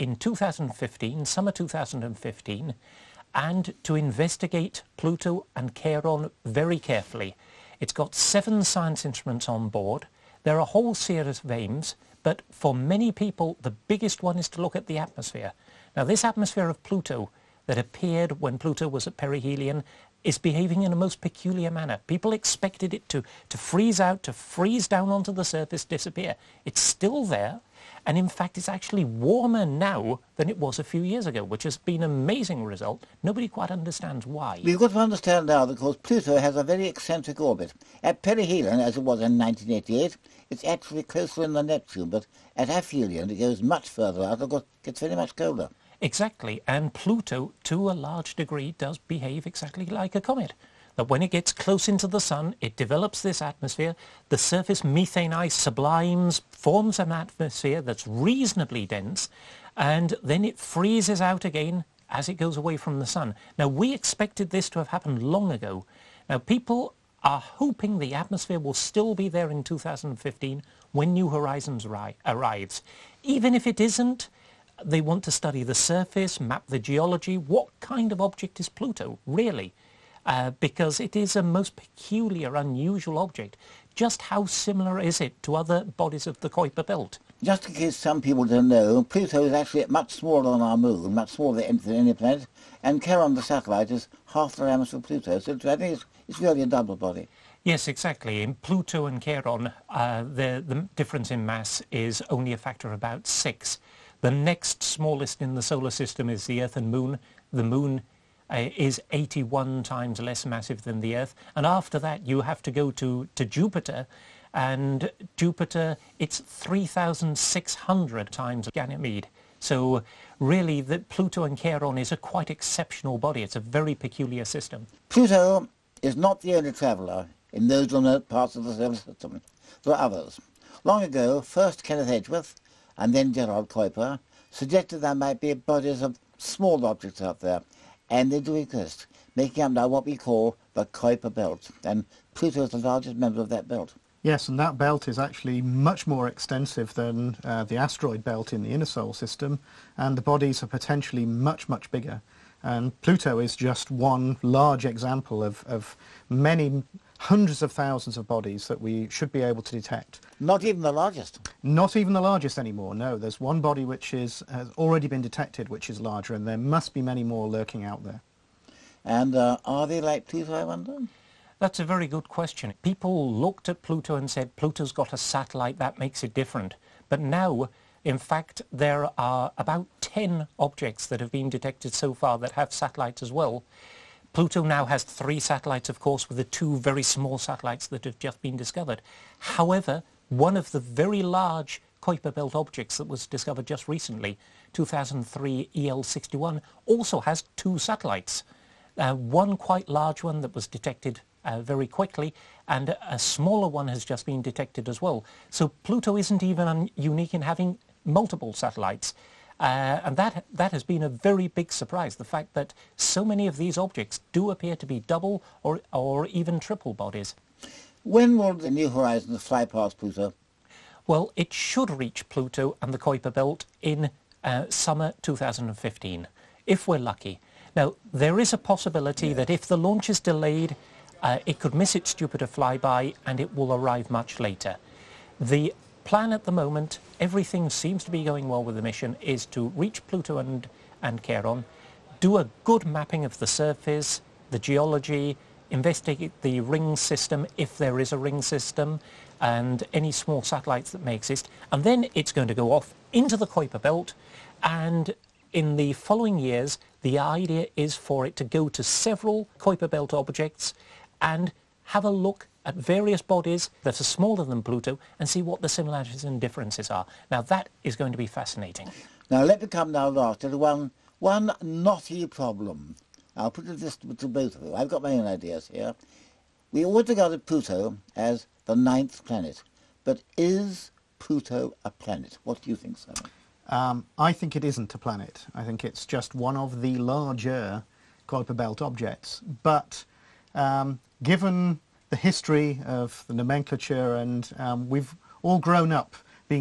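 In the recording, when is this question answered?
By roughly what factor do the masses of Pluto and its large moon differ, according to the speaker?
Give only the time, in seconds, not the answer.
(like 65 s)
103 s.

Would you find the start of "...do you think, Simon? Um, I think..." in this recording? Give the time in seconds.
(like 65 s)
282 s.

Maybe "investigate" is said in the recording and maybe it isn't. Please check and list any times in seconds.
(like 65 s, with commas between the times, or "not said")
3 s, 245 s.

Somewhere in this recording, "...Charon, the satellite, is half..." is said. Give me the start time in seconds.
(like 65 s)
93 s.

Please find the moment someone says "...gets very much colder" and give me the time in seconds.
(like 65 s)
44 s.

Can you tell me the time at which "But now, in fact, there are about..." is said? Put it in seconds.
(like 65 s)
177 s.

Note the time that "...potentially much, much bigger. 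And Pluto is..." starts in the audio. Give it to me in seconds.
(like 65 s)
150 s.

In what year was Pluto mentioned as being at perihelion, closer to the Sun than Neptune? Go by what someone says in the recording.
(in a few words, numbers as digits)
1988.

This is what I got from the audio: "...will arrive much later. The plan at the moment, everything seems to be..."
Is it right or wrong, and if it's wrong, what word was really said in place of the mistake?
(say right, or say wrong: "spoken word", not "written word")
right.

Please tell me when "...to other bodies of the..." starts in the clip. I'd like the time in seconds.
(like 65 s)
85 s.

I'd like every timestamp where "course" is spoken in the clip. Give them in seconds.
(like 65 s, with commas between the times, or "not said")
35 s, 44 s, 185 s.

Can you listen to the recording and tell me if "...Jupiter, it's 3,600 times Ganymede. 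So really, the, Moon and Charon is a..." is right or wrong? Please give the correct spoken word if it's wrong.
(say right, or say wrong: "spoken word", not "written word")
wrong: "Pluto", not "Moon".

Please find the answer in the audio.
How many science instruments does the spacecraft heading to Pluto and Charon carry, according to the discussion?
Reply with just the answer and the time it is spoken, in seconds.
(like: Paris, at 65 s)
7, at 8 s.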